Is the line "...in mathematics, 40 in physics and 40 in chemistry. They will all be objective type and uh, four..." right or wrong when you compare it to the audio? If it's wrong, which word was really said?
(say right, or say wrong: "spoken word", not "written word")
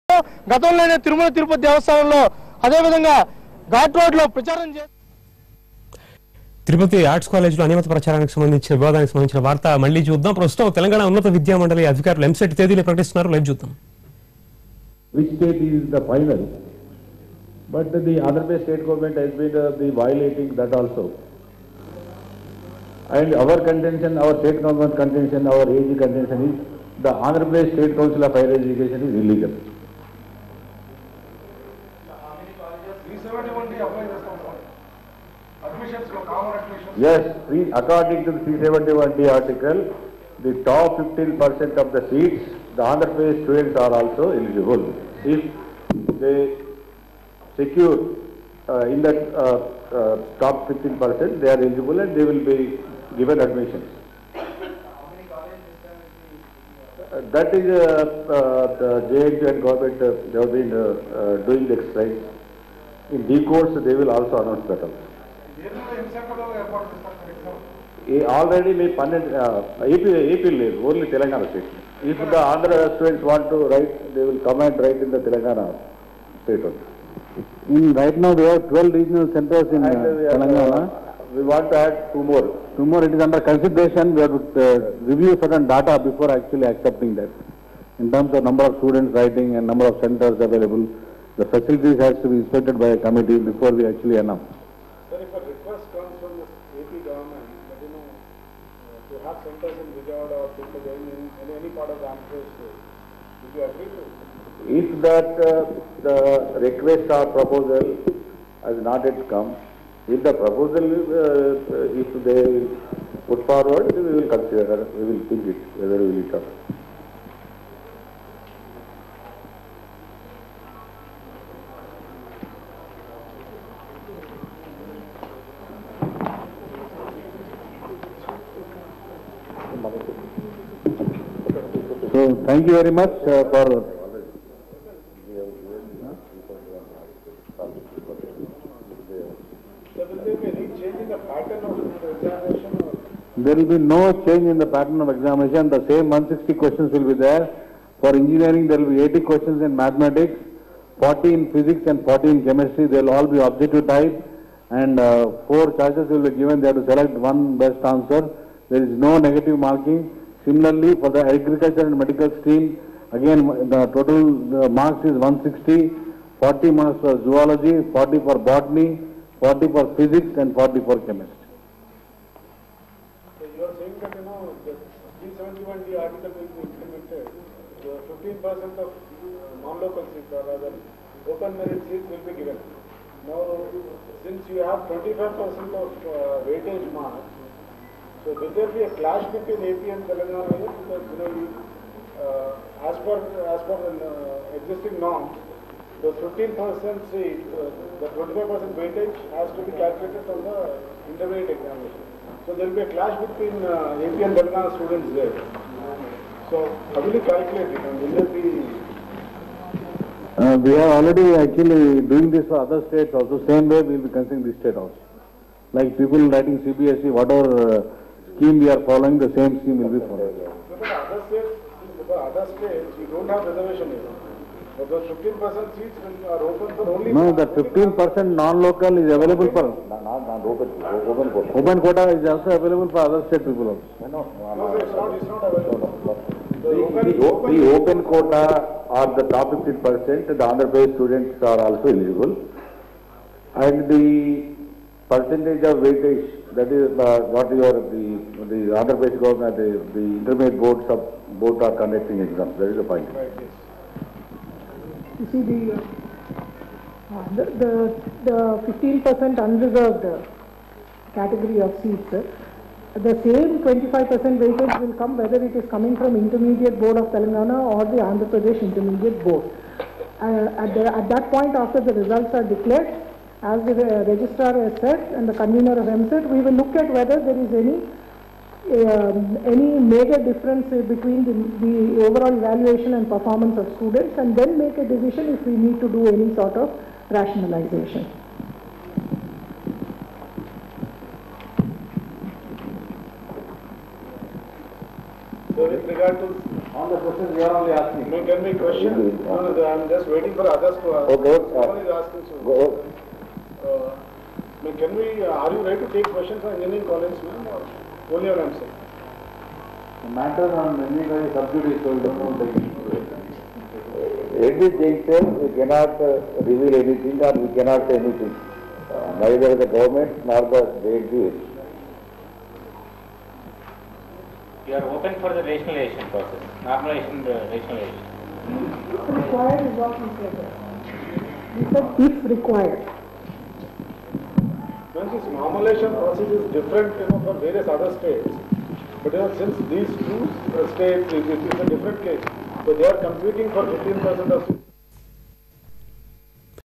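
right.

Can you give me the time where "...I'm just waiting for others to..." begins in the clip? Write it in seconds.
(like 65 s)
299 s.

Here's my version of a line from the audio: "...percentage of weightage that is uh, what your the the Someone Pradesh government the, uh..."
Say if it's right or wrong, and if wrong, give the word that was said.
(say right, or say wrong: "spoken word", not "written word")
wrong: "Andhra", not "Someone".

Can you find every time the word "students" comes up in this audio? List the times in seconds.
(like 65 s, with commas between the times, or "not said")
43 s, 72 s, 88 s, 204 s, 240 s, 283 s.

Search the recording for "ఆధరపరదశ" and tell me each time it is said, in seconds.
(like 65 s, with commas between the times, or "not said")
18 s, 27 s.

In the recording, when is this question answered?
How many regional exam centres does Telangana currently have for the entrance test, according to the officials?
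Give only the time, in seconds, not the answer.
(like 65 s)
78 s.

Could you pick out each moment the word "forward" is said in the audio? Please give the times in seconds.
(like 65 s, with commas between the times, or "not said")
113 s.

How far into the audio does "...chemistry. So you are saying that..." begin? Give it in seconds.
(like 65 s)
171 s.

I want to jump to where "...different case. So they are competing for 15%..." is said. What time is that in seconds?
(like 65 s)
341 s.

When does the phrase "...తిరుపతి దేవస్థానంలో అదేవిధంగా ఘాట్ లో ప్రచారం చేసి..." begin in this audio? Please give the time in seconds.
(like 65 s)
1 s.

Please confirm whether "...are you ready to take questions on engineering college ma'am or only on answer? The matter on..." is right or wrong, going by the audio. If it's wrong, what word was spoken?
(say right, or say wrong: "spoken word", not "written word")
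right.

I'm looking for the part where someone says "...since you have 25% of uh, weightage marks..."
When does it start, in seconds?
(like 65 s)
184 s.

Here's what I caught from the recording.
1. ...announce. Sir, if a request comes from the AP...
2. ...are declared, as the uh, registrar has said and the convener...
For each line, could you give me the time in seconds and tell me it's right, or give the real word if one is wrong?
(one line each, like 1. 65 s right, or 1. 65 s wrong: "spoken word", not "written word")
1. 94 s right
2. 272 s right.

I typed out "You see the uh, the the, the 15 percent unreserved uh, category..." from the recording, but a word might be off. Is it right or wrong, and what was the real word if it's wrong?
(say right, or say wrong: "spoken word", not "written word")
right.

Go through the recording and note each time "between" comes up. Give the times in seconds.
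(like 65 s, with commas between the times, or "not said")
189 s, 203 s, 280 s.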